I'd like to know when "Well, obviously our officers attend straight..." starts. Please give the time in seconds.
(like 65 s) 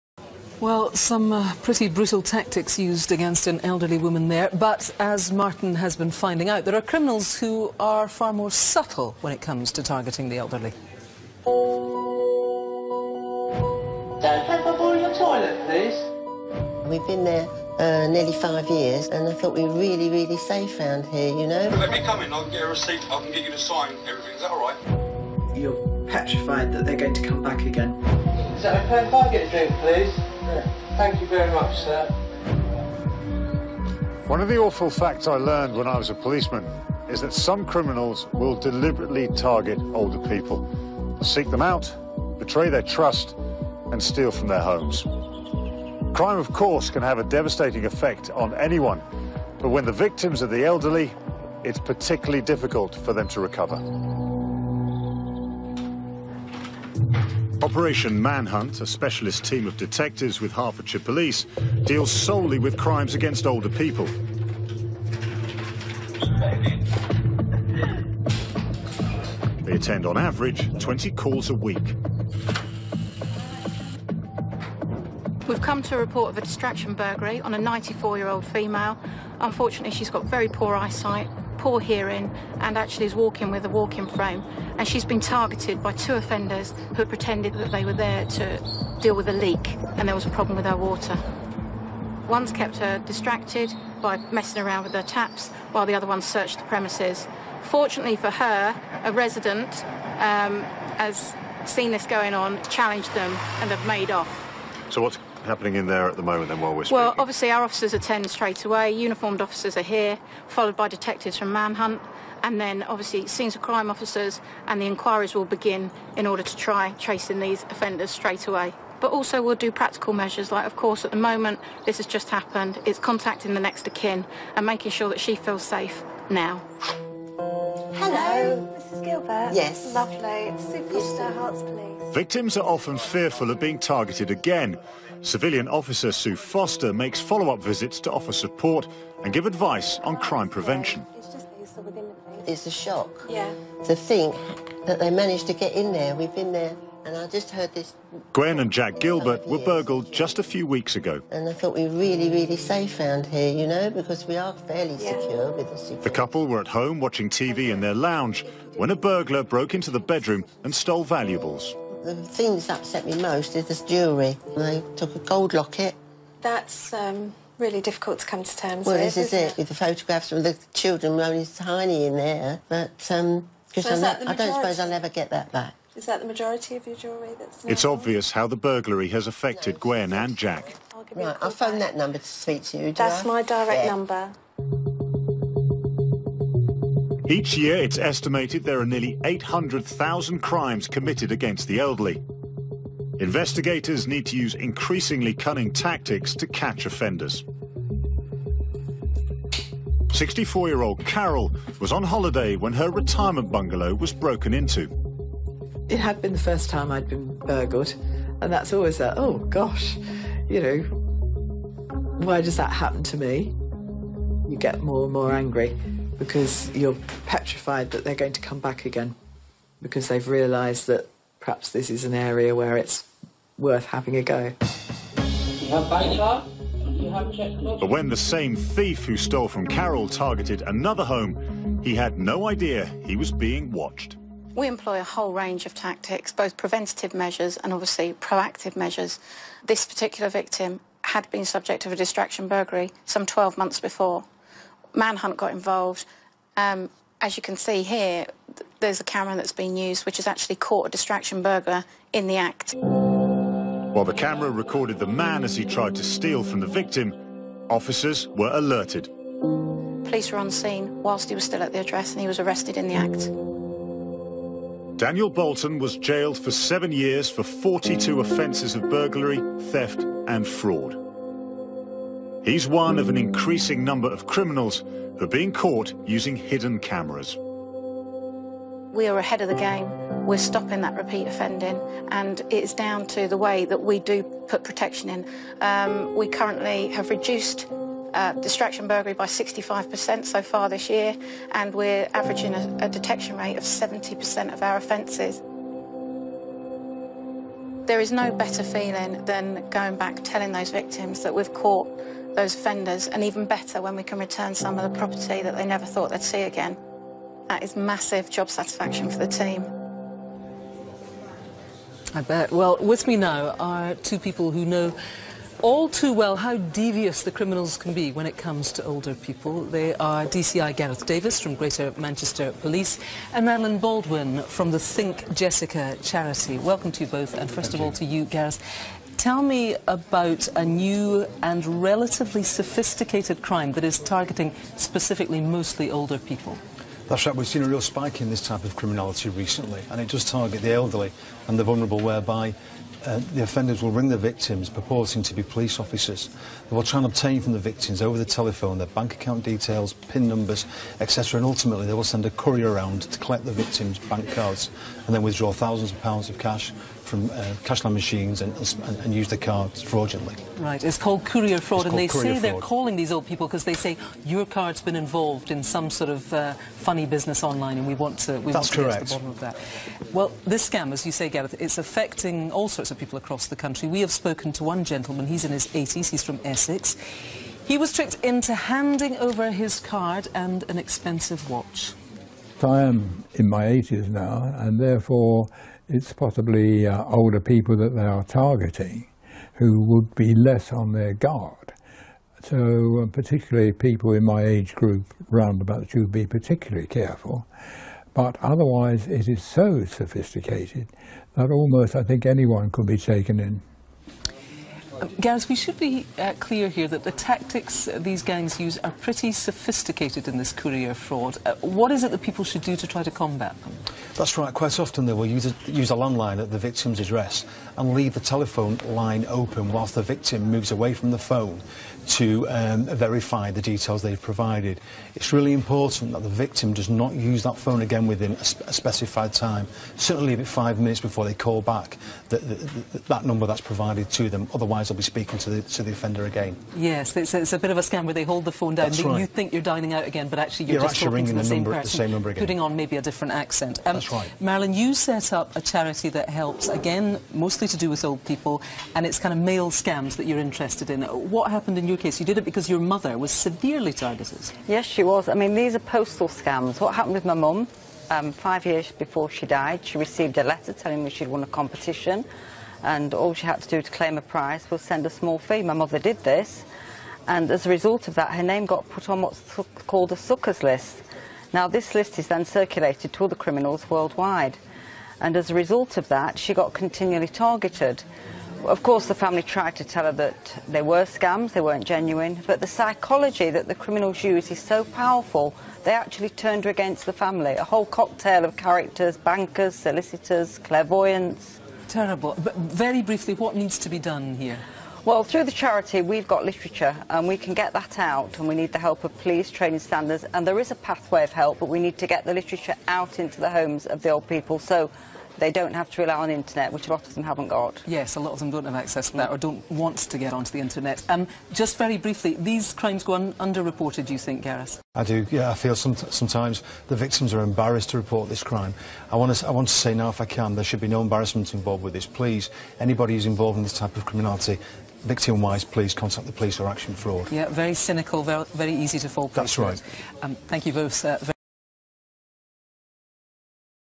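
106 s.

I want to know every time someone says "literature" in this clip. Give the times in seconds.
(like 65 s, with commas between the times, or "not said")
496 s, 502 s.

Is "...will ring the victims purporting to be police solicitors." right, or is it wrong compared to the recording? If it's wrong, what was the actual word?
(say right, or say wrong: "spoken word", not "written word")
wrong: "officers", not "solicitors".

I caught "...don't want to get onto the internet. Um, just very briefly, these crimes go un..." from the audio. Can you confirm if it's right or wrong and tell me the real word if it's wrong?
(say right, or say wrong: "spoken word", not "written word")
right.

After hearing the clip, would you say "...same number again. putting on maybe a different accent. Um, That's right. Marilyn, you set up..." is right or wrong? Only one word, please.
right.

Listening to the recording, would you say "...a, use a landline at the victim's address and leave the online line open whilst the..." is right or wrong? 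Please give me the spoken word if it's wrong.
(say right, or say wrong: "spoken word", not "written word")
wrong: "telephone", not "online".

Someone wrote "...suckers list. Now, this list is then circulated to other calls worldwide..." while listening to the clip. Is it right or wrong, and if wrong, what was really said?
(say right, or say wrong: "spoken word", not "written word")
wrong: "criminals", not "calls".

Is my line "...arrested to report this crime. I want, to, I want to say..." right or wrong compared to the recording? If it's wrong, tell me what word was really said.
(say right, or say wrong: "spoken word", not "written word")
wrong: "embarrassed", not "arrested".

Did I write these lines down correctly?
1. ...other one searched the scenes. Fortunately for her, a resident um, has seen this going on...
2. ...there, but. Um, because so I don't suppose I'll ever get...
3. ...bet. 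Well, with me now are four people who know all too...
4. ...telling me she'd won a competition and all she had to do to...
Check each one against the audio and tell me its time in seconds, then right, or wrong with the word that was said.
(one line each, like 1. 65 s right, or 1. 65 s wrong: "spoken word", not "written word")
1. 95 s wrong: "premises", not "scenes"
2. 172 s right
3. 312 s wrong: "two", not "four"
4. 460 s right.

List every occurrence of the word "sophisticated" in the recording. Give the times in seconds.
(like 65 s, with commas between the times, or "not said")
332 s, 399 s, 409 s.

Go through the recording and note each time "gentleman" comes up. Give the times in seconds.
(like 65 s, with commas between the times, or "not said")
374 s.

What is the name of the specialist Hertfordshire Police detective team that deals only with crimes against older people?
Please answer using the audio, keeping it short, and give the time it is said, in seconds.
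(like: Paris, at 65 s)
Operation Manhunt, at 57 s.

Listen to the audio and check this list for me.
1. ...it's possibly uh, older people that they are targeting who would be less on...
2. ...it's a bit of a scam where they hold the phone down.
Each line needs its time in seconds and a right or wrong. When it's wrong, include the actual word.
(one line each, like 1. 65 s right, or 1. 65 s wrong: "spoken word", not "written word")
1. 385 s right
2. 437 s right.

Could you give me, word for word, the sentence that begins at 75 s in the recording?
We've come to a report of a distraction burglary on a 94-year-old female.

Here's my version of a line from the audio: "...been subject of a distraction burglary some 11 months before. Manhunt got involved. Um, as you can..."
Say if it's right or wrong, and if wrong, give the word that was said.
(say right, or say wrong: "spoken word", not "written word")
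wrong: "12", not "11".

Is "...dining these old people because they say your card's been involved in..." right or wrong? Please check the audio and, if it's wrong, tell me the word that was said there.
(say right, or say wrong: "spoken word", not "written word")
wrong: "calling", not "dining".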